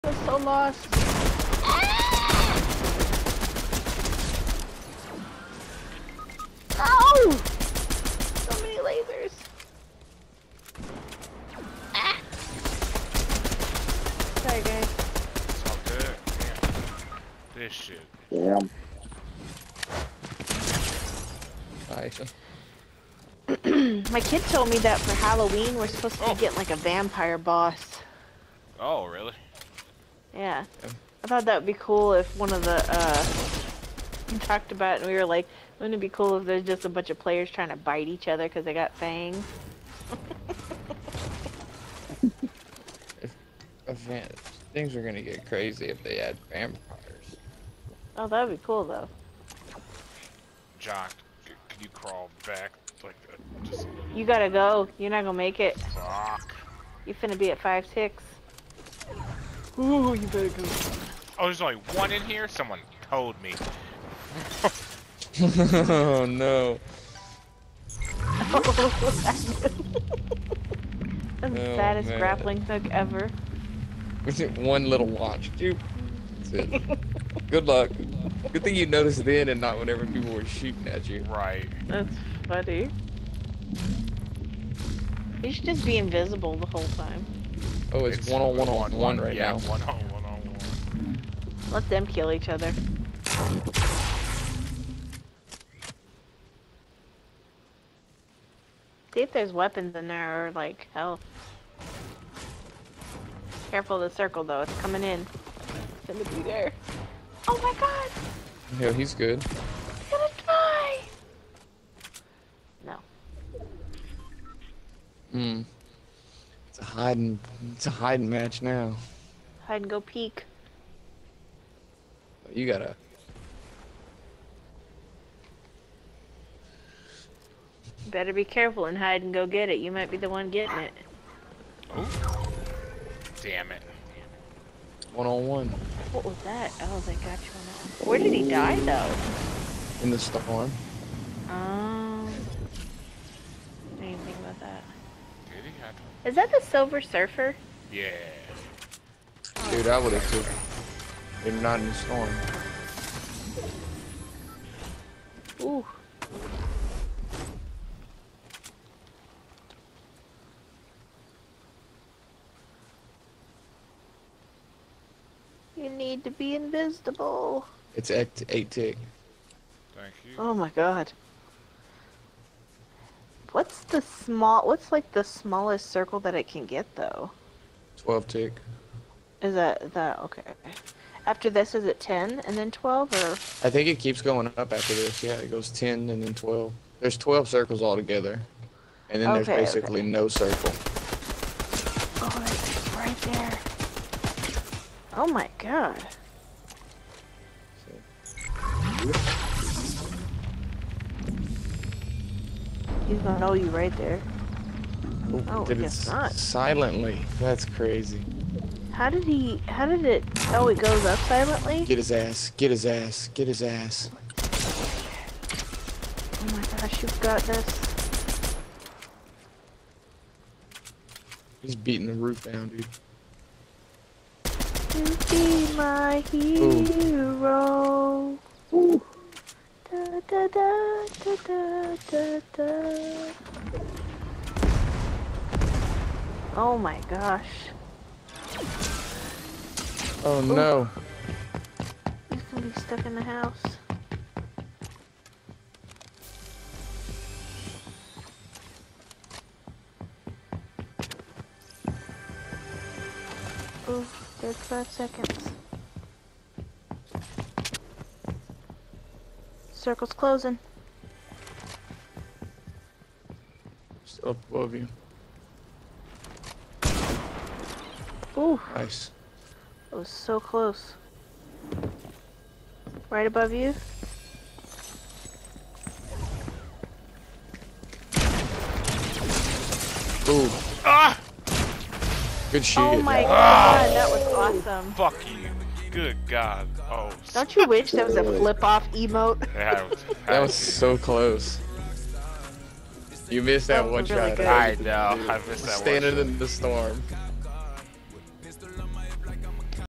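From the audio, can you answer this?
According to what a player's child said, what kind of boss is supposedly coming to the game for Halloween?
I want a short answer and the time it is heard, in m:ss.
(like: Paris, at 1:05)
vampire boss, at 0:26.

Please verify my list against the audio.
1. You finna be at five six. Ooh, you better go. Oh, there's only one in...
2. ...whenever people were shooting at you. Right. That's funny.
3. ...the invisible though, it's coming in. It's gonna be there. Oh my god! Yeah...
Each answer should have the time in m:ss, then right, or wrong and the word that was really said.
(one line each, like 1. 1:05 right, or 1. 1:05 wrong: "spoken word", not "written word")
1. 0:57 right
2. 1:19 right
3. 1:44 wrong: "circle", not "invisible".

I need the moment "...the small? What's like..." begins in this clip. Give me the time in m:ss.
2:53.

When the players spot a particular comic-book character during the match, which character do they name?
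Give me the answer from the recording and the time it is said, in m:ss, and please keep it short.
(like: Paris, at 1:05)
Silver Surfer, at 2:26.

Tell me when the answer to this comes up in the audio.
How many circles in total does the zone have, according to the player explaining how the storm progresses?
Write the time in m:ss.
3:07.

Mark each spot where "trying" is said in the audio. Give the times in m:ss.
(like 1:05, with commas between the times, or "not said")
0:37.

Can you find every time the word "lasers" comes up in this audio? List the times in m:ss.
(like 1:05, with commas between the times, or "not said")
0:08.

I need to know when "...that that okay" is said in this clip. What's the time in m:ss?
2:59.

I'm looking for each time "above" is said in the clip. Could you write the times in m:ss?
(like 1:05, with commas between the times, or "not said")
4:24, 4:33.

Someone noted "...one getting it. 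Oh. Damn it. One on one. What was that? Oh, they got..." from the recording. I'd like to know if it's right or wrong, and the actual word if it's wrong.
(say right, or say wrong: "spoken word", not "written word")
right.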